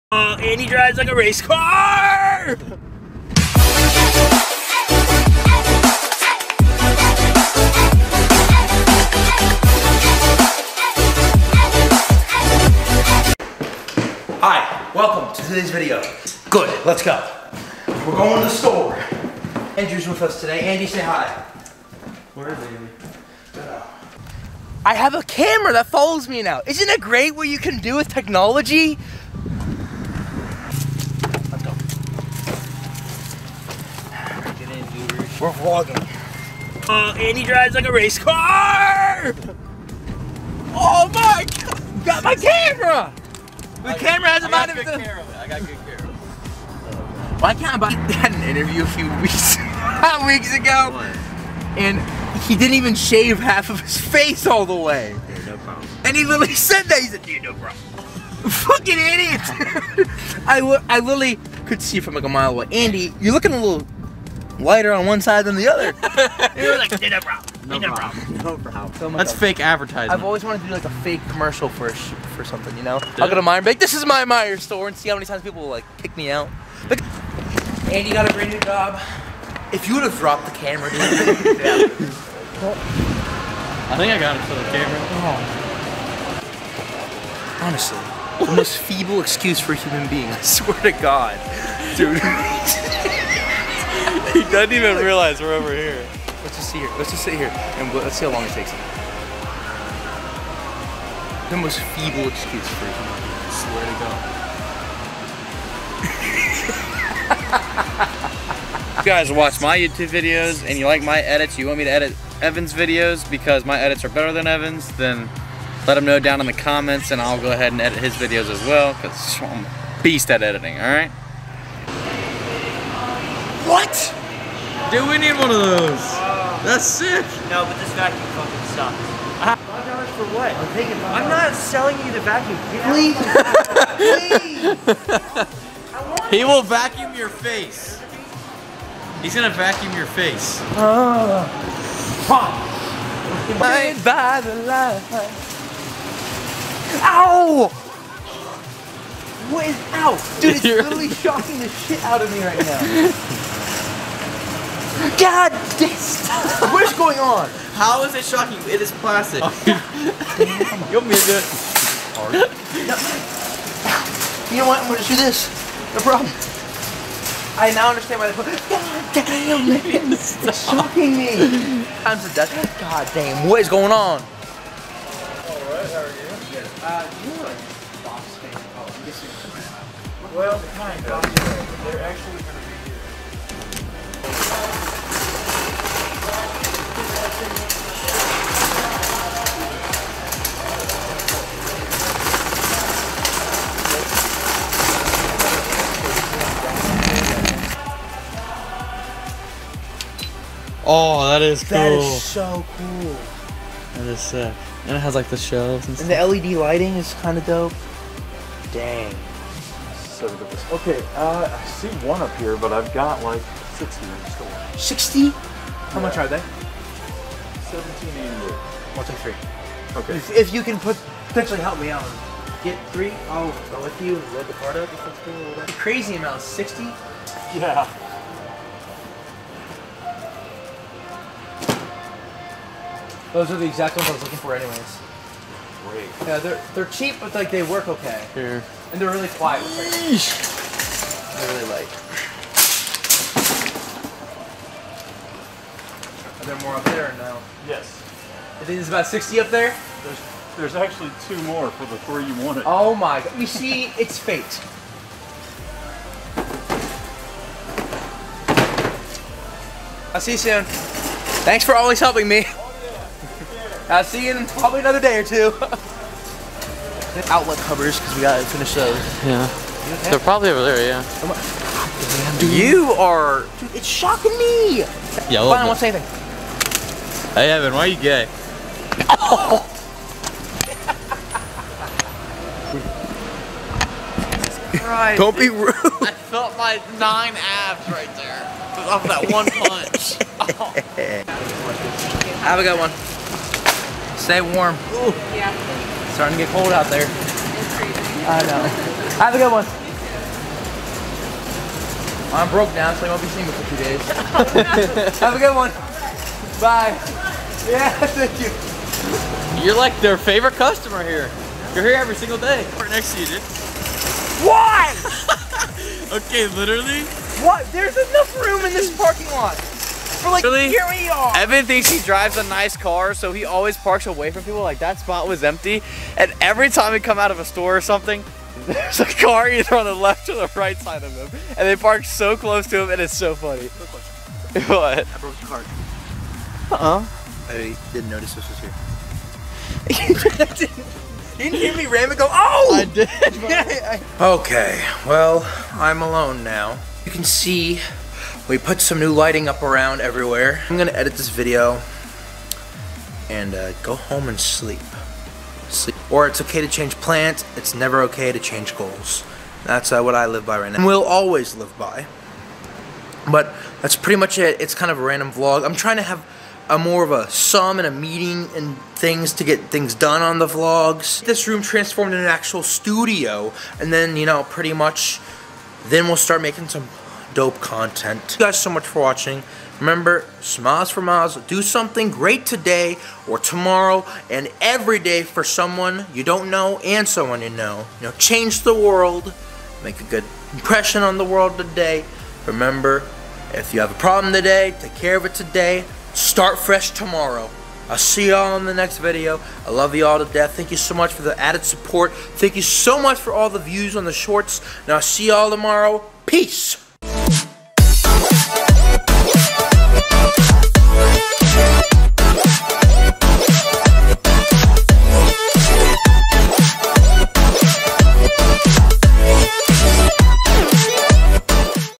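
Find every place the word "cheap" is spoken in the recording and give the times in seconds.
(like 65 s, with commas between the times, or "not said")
236 s.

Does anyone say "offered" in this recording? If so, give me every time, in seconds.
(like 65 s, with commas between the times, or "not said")
not said.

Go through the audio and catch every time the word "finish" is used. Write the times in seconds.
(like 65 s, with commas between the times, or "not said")
268 s.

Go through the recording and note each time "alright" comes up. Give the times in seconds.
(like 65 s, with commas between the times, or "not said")
120 s, 174 s.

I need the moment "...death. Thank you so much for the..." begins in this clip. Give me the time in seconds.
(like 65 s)
400 s.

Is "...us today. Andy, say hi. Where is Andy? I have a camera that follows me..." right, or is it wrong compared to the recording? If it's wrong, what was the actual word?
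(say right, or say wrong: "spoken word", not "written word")
right.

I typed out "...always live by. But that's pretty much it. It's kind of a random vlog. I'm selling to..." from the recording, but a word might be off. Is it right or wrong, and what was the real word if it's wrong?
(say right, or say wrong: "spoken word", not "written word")
wrong: "trying", not "selling".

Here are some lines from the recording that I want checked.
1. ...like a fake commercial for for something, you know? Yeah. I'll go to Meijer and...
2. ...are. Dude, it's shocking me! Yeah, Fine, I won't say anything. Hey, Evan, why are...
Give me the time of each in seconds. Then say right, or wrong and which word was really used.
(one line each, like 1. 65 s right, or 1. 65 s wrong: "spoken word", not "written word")
1. 70 s right
2. 272 s right.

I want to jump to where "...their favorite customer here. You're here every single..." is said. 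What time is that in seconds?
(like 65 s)
310 s.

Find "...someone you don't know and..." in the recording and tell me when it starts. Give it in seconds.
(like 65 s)
385 s.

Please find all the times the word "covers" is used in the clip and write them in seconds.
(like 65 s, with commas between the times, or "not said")
267 s.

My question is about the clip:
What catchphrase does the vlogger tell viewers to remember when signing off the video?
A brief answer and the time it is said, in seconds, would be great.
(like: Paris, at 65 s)
smiles for miles, at 380 s.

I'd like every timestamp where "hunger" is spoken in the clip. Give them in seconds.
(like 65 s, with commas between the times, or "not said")
not said.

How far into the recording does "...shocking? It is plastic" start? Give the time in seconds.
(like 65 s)
158 s.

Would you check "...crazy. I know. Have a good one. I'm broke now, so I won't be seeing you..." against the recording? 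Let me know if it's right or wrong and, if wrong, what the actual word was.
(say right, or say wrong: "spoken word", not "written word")
right.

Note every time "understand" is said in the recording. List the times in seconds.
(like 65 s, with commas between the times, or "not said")
167 s.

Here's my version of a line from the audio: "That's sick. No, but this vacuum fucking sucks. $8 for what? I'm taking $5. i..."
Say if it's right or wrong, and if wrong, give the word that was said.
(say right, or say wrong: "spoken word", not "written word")
wrong: "5", not "8".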